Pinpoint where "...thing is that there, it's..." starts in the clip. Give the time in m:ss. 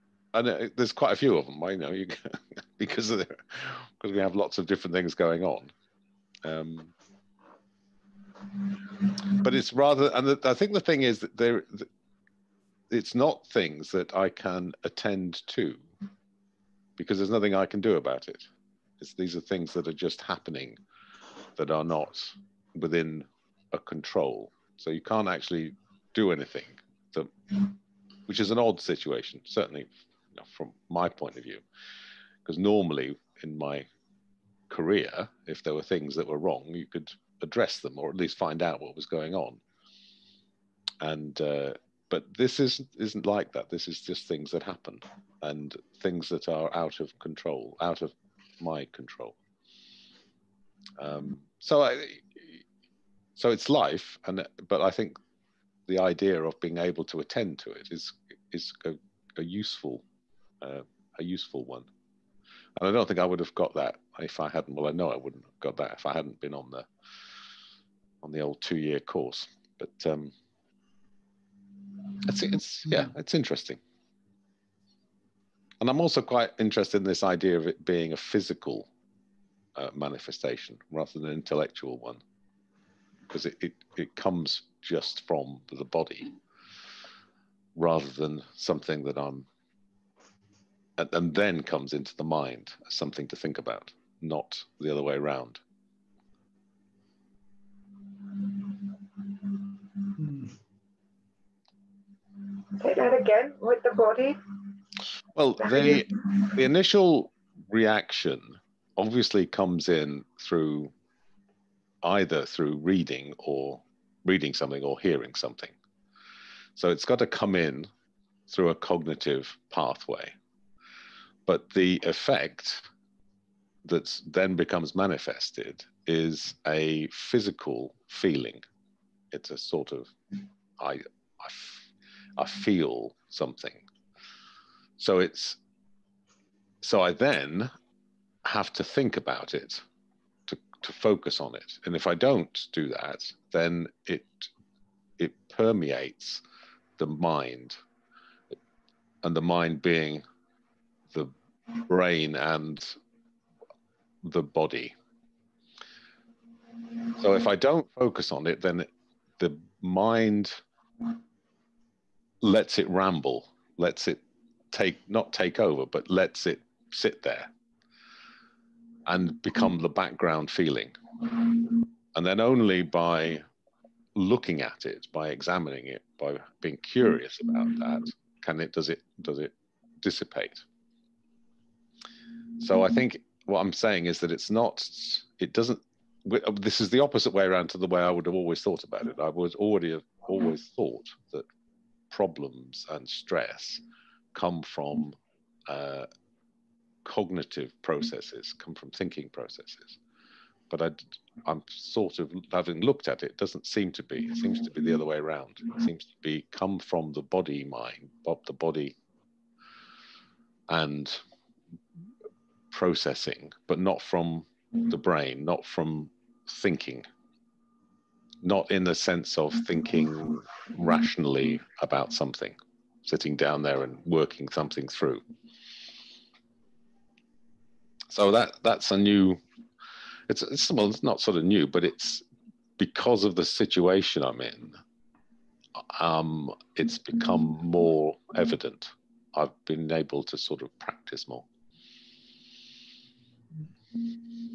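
0:10.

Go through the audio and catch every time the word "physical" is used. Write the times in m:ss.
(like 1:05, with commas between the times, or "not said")
1:18, 2:07.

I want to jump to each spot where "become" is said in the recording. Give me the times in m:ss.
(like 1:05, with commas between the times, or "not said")
2:04, 2:49, 3:56.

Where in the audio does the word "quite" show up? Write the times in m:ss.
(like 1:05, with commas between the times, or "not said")
0:00, 1:16.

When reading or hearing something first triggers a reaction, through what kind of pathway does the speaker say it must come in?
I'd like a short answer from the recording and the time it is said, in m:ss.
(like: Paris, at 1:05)
cognitive pathway, at 1:58.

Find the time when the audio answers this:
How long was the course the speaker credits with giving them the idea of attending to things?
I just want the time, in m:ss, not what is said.
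1:08.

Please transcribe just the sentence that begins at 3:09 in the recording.
I would already have always thought that problems and stress come from uh, cognitive processes, come from thinking processes.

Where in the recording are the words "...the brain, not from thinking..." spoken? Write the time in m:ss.
3:34.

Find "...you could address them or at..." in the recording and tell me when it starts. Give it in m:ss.
0:36.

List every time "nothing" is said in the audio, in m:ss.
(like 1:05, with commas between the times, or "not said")
0:17.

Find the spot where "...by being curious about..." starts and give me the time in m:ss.
2:56.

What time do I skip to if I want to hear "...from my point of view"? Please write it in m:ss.
0:30.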